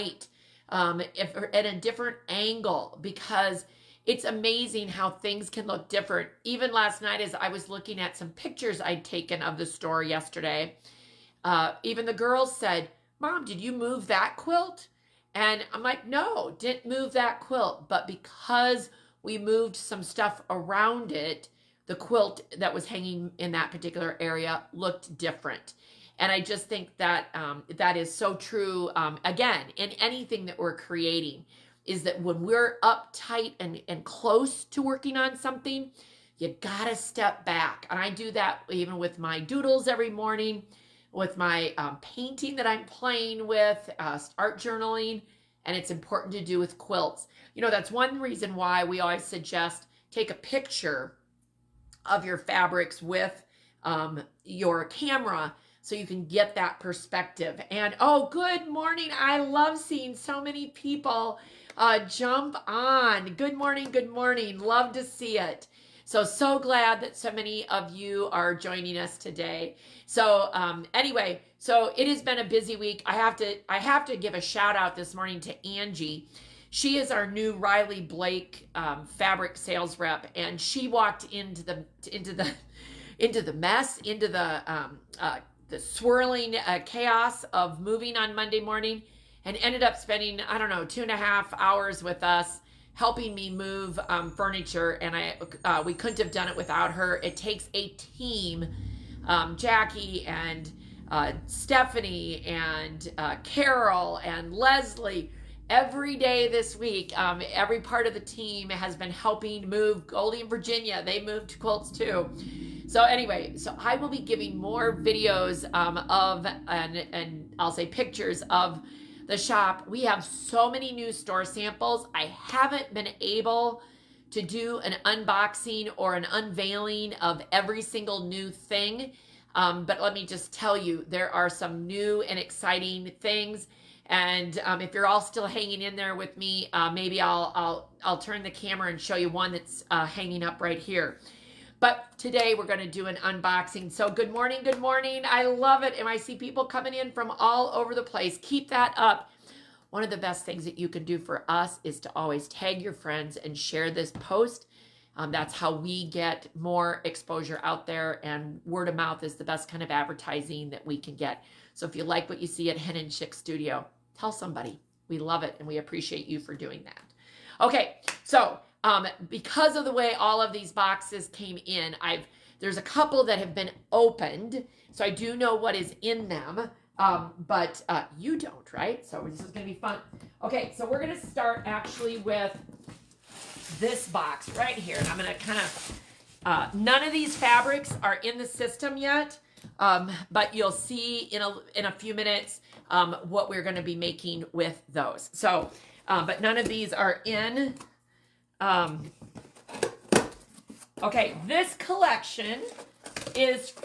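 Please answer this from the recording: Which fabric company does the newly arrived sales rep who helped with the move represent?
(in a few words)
Riley Blake.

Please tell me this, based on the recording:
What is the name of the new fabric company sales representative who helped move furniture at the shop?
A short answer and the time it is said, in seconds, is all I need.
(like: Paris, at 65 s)
Angie, at 75 s.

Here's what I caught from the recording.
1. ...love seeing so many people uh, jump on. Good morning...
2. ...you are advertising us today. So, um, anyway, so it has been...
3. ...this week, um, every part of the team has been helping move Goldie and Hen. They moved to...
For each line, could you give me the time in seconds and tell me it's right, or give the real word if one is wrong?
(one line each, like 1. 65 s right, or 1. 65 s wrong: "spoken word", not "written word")
1. 59 s right
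2. 67 s wrong: "joining", not "advertising"
3. 106 s wrong: "Virginia", not "Hen".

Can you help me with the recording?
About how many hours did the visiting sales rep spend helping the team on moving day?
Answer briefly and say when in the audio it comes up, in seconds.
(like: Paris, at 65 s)
2.5 hours, at 90 s.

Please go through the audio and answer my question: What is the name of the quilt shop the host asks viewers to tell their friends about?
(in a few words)
Hen and Chick Studio.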